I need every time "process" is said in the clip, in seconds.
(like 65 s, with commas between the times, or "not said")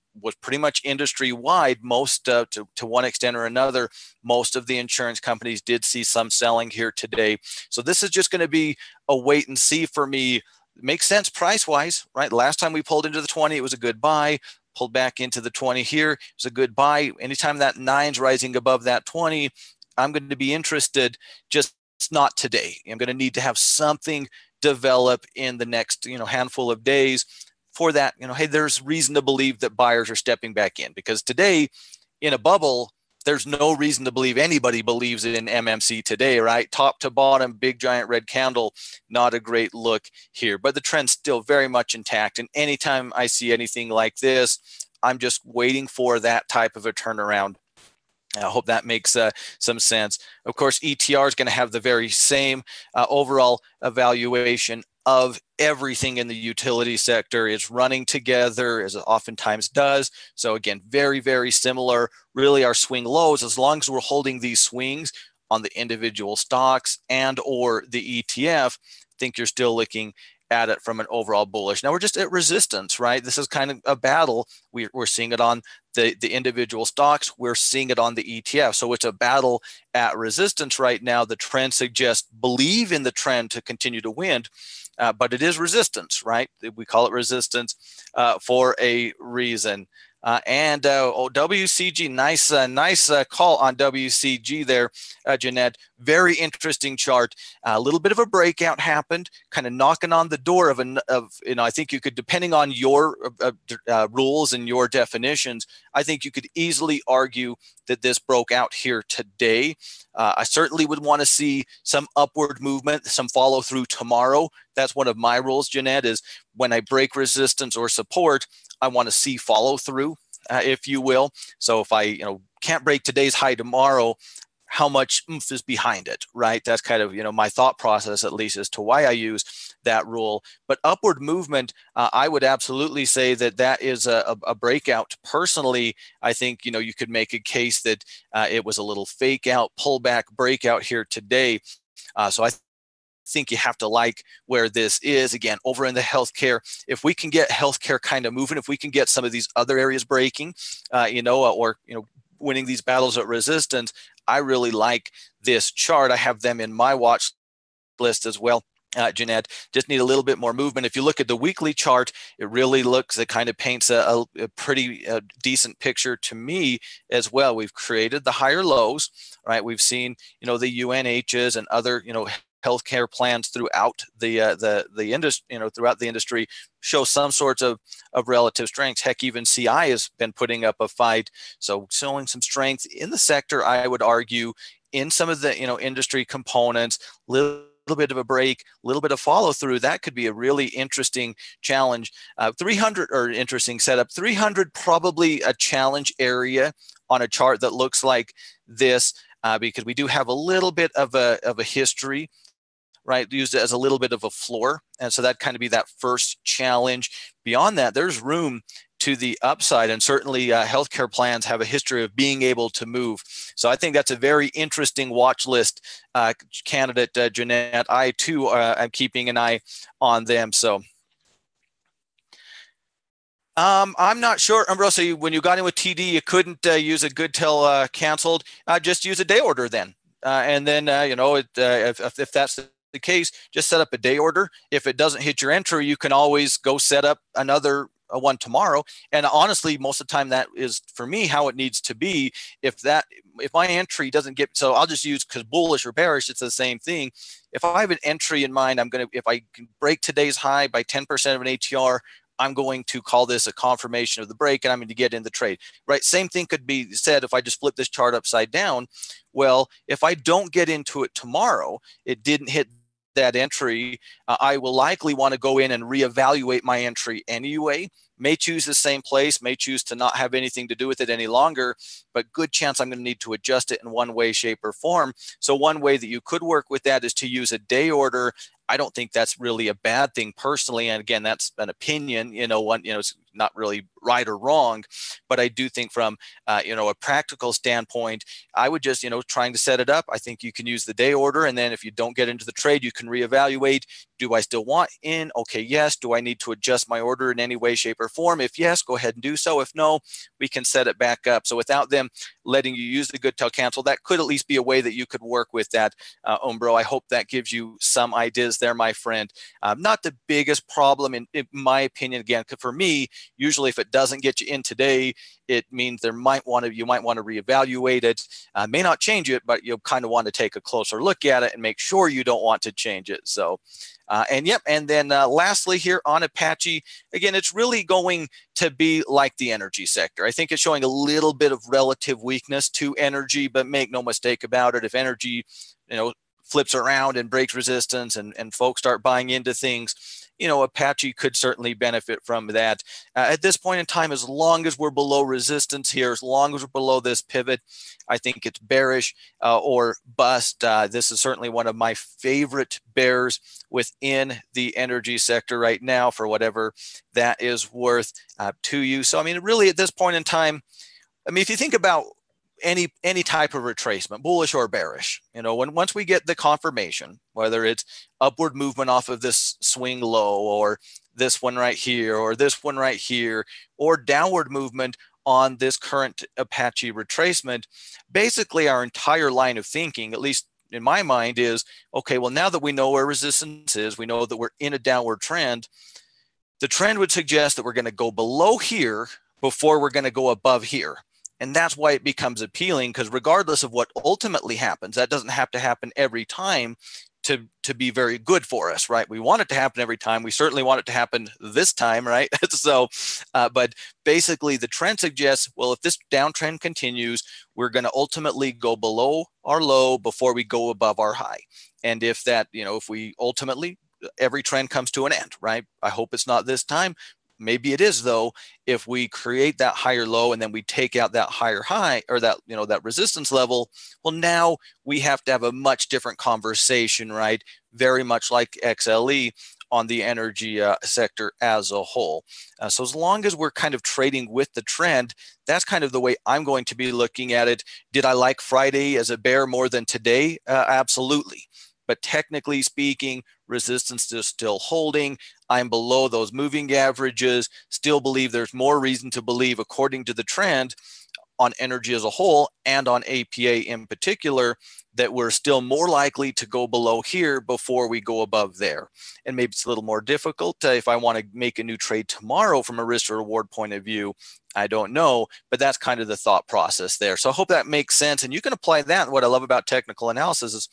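127 s, 466 s.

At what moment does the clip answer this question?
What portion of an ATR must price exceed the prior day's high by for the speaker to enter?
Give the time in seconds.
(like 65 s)
250 s.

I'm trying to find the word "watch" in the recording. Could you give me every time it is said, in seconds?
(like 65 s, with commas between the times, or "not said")
156 s, 215 s.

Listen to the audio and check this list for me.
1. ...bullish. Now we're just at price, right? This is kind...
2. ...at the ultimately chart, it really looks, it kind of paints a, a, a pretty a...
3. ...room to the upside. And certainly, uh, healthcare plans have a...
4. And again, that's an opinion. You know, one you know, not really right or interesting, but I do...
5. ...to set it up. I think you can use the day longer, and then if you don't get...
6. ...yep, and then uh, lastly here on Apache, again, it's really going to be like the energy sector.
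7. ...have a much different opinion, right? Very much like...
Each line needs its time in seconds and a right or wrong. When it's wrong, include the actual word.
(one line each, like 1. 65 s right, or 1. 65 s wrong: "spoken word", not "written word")
1. 71 s wrong: "resistance", not "price"
2. 161 s wrong: "weekly", not "ultimately"
3. 208 s right
4. 280 s wrong: "wrong", not "interesting"
5. 289 s wrong: "order", not "longer"
6. 324 s right
7. 425 s wrong: "conversation", not "opinion".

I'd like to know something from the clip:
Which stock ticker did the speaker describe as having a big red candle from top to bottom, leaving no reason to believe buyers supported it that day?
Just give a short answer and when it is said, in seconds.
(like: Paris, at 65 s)
MMC, at 35 s.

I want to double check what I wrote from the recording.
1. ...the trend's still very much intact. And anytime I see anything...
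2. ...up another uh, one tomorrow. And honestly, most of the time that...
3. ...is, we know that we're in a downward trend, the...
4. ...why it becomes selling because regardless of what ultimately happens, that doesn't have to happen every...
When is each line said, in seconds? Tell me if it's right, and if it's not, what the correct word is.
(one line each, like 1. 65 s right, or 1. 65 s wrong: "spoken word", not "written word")
1. 40 s right
2. 237 s right
3. 383 s right
4. 391 s wrong: "appealing", not "selling".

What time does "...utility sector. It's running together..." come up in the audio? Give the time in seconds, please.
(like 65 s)
56 s.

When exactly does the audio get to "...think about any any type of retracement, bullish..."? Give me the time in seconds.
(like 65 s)
361 s.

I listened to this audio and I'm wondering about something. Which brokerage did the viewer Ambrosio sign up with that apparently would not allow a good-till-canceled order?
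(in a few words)
TD.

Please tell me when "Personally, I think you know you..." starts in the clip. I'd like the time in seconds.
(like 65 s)
135 s.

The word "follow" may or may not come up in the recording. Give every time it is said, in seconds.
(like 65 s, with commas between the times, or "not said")
113 s, 119 s, 189 s.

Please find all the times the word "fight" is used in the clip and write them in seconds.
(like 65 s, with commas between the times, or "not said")
180 s.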